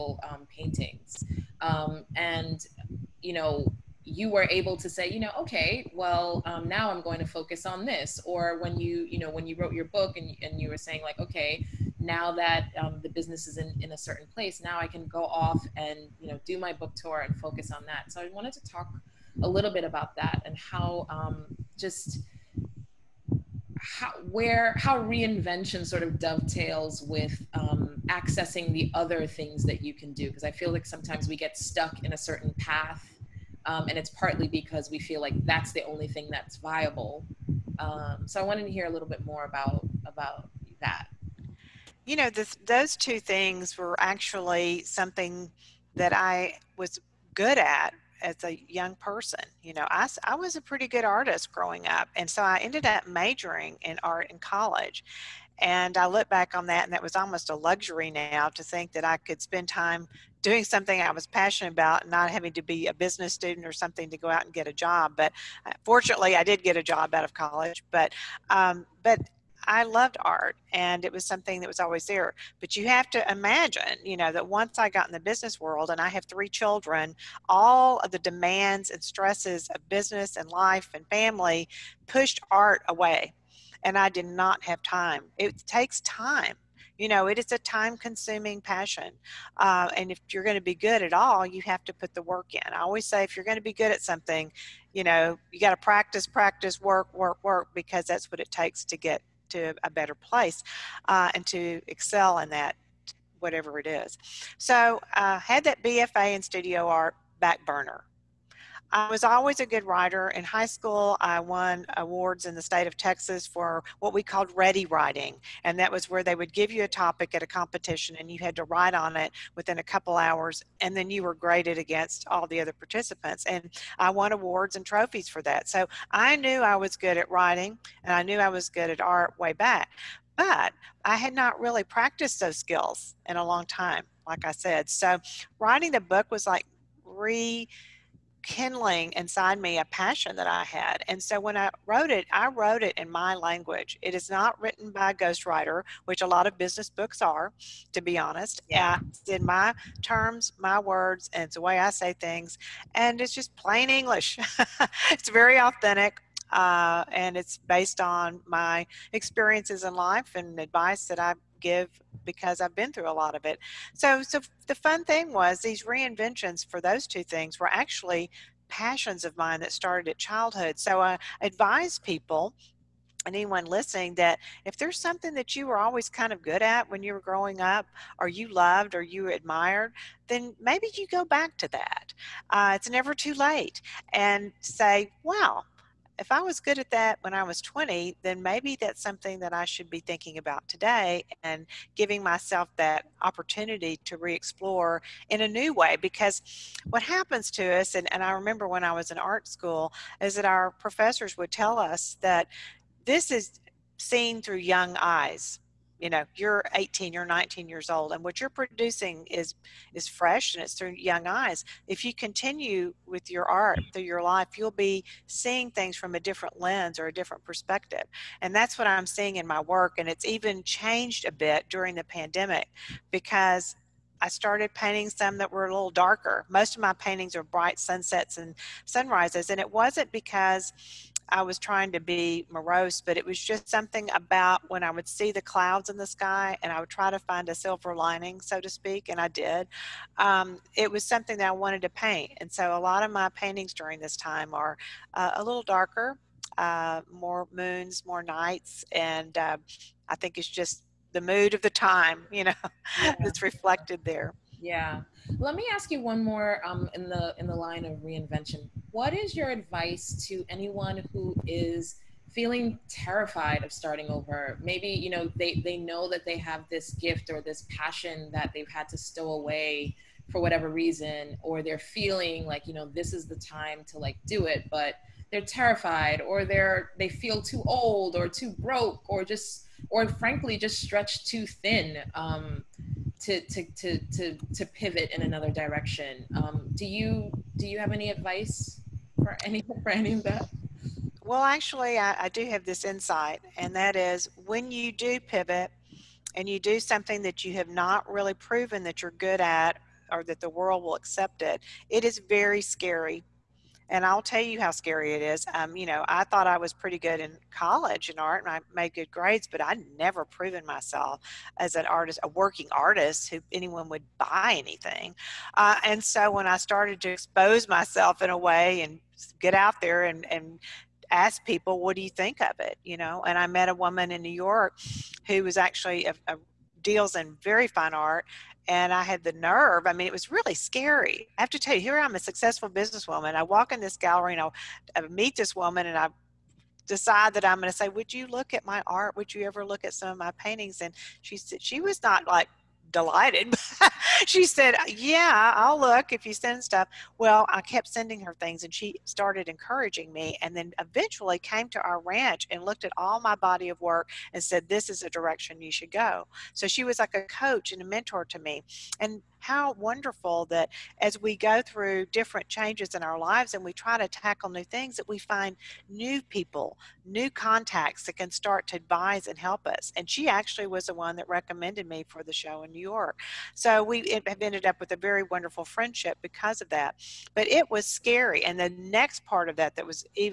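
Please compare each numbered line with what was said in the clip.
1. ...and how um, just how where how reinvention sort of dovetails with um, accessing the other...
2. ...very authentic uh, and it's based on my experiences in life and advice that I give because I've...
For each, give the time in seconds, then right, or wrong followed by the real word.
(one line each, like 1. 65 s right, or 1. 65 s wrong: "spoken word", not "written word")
1. 20 s right
2. 155 s right.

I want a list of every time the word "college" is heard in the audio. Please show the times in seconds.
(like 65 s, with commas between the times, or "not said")
54 s, 67 s, 307 s.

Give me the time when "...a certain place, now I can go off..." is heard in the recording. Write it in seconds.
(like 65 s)
13 s.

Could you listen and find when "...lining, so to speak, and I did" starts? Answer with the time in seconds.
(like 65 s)
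237 s.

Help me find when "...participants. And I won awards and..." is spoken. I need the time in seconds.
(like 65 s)
122 s.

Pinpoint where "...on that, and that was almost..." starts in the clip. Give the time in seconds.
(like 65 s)
56 s.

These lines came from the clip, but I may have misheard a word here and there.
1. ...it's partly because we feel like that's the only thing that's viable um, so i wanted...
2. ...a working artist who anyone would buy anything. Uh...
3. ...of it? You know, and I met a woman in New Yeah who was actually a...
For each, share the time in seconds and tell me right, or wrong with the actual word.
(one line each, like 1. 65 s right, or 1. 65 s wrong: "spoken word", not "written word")
1. 33 s right
2. 312 s right
3. 322 s wrong: "York", not "Yeah".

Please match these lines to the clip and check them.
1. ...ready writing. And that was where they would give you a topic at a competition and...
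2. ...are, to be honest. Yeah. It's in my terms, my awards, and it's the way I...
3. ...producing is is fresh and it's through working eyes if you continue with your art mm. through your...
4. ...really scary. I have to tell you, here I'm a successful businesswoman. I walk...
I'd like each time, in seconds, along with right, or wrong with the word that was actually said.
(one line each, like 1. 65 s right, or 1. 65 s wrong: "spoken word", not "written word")
1. 114 s right
2. 147 s wrong: "words", not "awards"
3. 208 s wrong: "young", not "working"
4. 330 s right.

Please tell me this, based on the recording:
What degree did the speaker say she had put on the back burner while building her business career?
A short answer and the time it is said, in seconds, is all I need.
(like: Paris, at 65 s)
BFA in studio art, at 105 s.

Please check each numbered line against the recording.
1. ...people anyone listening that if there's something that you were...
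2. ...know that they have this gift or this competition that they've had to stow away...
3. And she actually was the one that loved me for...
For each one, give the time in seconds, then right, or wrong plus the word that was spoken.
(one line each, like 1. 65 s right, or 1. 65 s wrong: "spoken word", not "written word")
1. 171 s right
2. 265 s wrong: "passion", not "competition"
3. 369 s wrong: "recommended", not "loved".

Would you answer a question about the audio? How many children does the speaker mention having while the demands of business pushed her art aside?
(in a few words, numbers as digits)
3.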